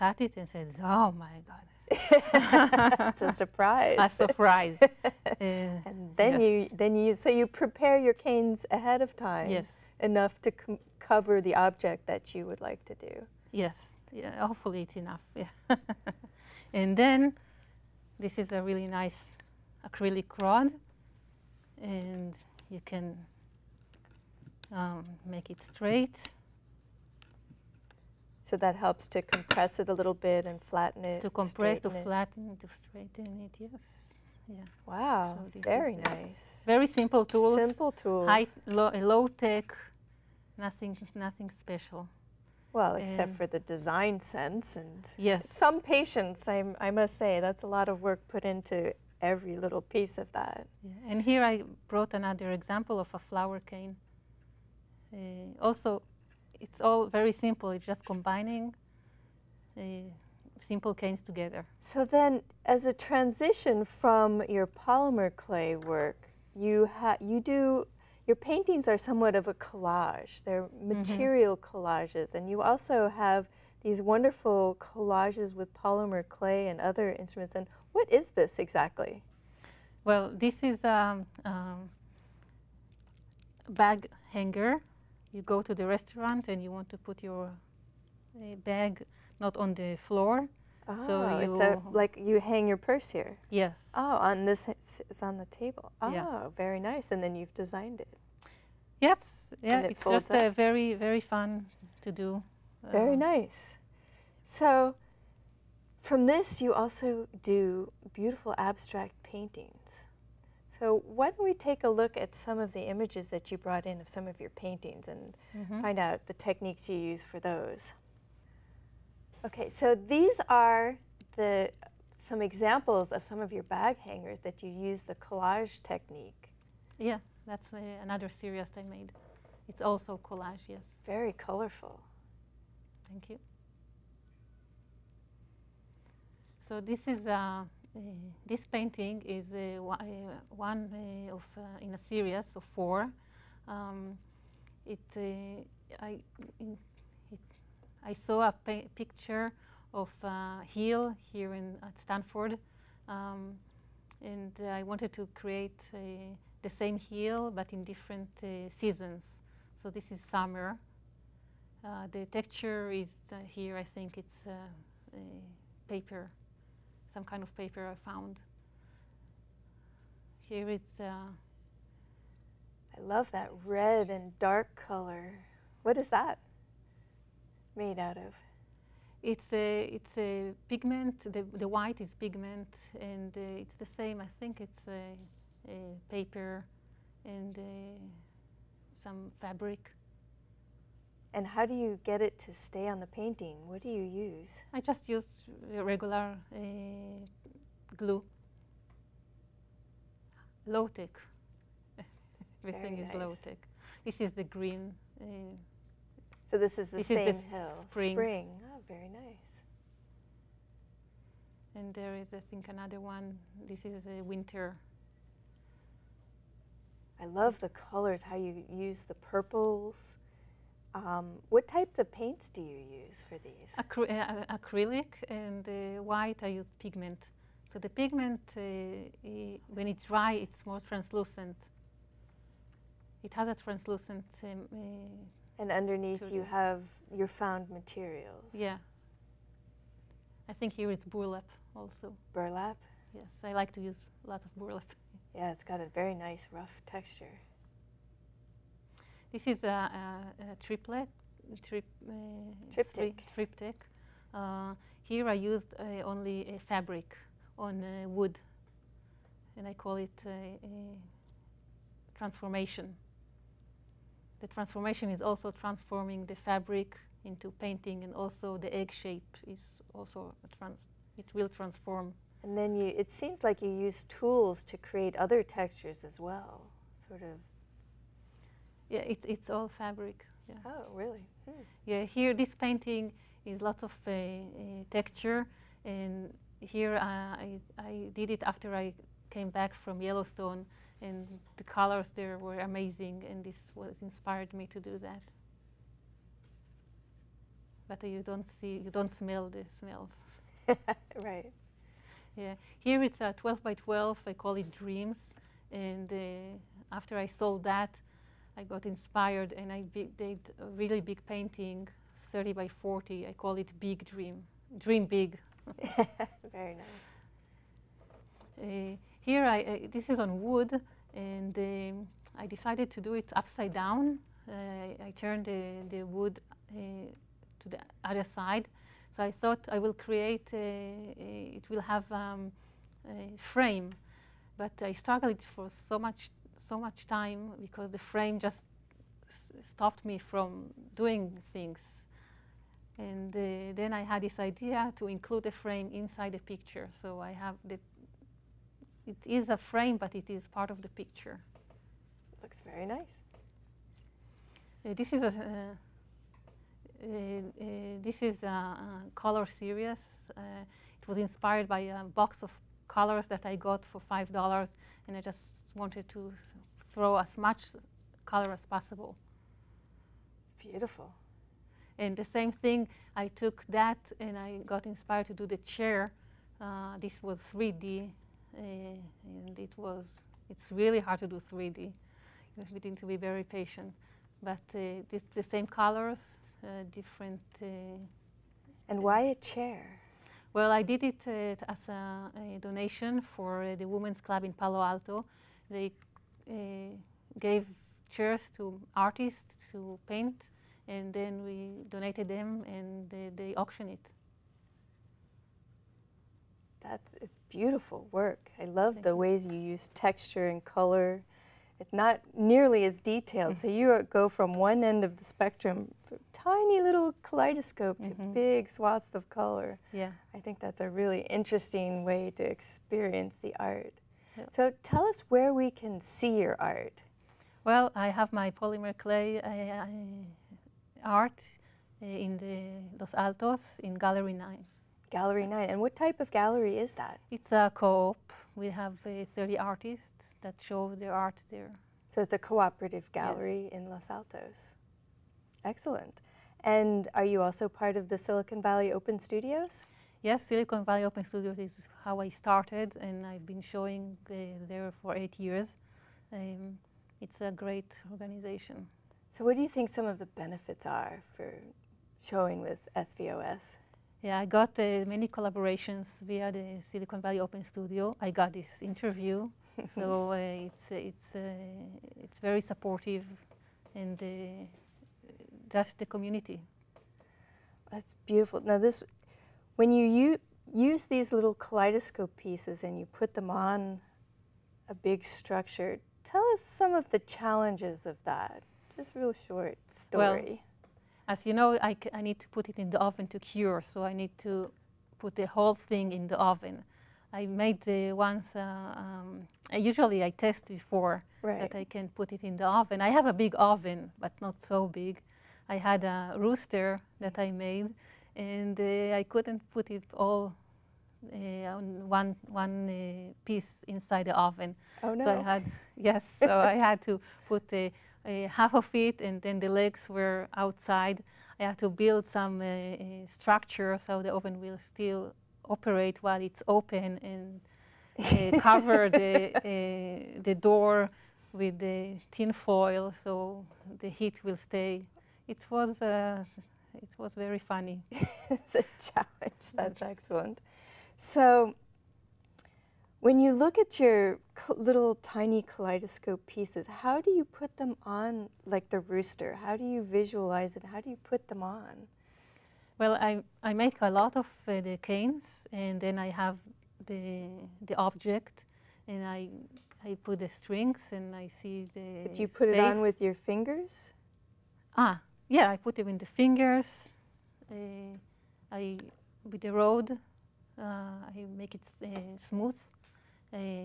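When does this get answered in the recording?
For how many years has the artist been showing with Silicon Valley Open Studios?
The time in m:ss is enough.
7:35.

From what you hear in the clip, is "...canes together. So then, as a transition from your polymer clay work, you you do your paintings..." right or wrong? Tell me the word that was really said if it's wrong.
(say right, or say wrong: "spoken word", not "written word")
right.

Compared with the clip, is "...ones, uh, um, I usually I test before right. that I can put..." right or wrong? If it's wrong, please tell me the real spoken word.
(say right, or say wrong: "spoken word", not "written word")
right.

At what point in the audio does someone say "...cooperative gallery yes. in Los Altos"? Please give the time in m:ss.
7:22.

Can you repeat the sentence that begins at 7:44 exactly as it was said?
Yeah, I got uh, many collaborations via the Silicon Valley Open Studio.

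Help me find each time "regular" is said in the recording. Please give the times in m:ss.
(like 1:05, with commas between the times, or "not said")
3:15.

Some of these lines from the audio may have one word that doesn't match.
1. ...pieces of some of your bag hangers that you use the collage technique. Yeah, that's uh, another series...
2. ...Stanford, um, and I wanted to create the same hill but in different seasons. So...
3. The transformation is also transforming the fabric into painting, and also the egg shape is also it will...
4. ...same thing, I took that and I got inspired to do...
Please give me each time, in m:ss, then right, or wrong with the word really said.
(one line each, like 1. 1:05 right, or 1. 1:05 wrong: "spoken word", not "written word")
1. 2:02 wrong: "examples", not "pieces"
2. 2:31 right
3. 4:24 right
4. 6:12 right.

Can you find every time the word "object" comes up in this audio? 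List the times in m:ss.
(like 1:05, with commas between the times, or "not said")
0:11, 9:17.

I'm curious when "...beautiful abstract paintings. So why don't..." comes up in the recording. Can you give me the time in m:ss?
1:48.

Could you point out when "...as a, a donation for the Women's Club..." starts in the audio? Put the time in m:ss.
6:31.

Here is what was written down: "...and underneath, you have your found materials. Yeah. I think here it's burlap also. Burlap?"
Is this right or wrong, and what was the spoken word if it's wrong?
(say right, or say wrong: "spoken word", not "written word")
right.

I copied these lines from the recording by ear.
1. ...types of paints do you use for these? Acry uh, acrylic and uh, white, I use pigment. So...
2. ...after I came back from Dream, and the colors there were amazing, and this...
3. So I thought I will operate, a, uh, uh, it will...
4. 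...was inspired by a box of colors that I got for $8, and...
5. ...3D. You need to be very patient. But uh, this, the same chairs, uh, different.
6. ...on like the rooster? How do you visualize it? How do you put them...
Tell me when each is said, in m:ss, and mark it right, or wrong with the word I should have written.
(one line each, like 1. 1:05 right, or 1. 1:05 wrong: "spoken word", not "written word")
1. 3:41 right
2. 4:48 wrong: "Yellowstone", not "Dream"
3. 5:29 wrong: "create", not "operate"
4. 6:01 wrong: "5", not "8"
5. 6:21 wrong: "colors", not "chairs"
6. 9:08 right.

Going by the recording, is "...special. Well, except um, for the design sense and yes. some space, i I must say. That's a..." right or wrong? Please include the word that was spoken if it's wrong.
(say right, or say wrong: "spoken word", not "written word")
wrong: "patience", not "space".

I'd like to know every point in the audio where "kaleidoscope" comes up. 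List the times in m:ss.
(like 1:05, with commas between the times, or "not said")
6:57, 8:01, 9:05.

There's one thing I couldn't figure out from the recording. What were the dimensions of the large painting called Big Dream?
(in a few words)
30 by 40.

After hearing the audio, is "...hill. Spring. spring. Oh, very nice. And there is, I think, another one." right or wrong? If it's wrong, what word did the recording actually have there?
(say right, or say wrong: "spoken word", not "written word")
right.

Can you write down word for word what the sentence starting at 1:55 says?
find out the techniques you use for those.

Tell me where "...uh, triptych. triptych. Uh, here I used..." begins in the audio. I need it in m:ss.
4:12.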